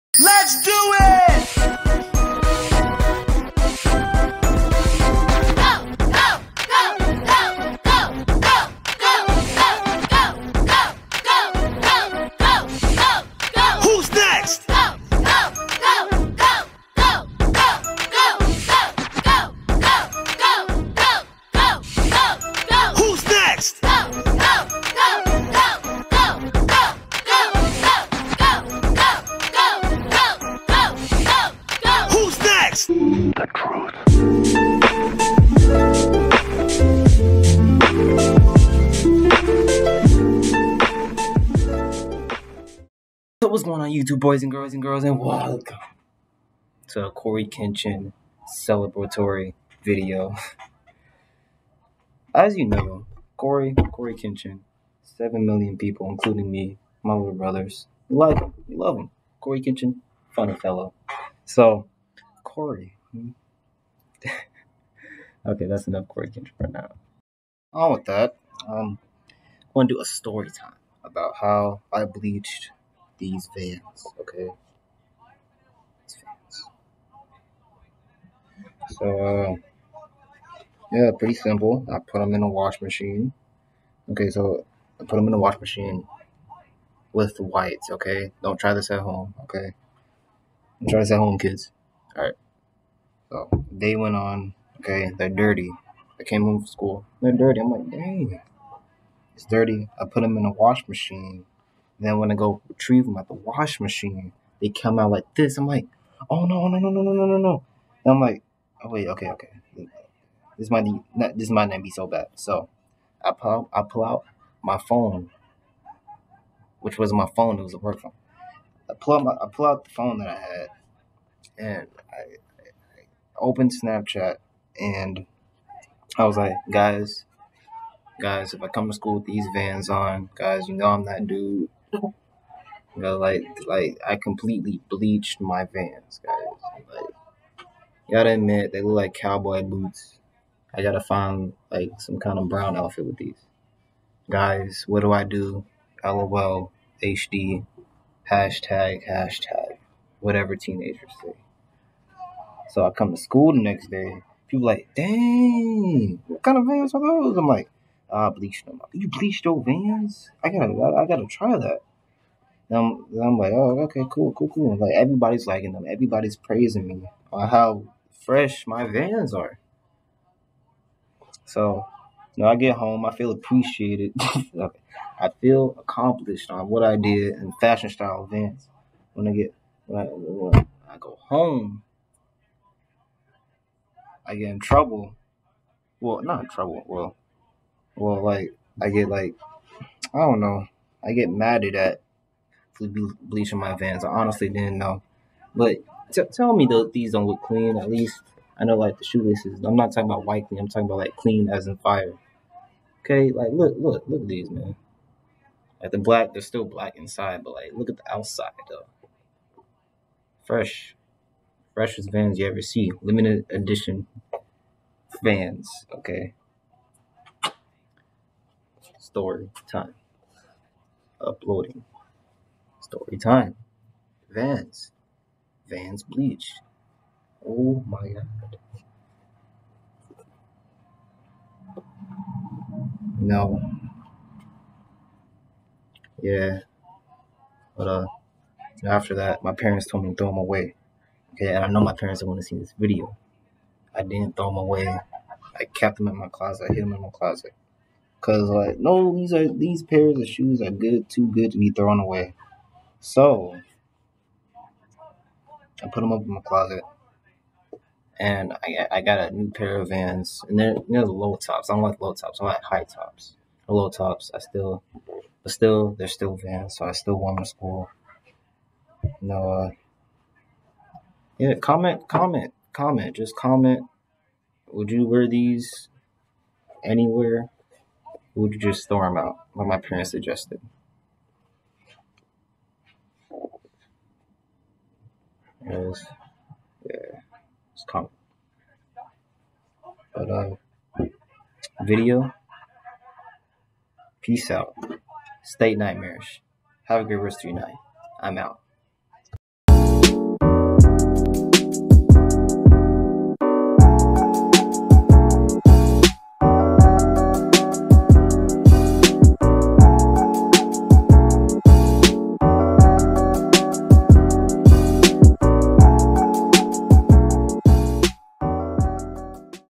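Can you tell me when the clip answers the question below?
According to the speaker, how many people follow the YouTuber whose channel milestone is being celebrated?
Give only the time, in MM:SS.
00:55.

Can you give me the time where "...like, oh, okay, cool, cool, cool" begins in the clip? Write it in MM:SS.
02:43.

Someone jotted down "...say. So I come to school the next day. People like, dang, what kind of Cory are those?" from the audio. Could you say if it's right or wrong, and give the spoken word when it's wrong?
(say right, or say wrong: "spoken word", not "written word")
wrong: "Vans", not "Cory".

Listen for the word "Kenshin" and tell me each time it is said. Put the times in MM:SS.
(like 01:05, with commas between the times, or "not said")
00:47, 00:54, 00:59.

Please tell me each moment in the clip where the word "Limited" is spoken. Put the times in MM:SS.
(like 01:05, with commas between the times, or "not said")
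03:33.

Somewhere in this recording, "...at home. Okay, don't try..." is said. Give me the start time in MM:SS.
01:28.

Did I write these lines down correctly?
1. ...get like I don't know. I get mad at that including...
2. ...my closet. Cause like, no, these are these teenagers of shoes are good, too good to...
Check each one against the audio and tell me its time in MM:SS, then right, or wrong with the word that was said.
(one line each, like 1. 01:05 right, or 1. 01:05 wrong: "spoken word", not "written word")
1. 03:08 wrong: "bleaching", not "including"
2. 04:07 wrong: "pairs", not "teenagers".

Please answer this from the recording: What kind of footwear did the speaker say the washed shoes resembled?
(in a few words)
cowboy boots.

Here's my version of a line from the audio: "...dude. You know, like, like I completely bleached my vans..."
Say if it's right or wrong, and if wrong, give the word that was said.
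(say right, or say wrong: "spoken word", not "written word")
right.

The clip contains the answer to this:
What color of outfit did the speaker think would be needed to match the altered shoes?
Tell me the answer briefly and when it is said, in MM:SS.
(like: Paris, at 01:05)
brown, at 02:22.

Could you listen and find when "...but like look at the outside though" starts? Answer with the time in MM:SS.
03:27.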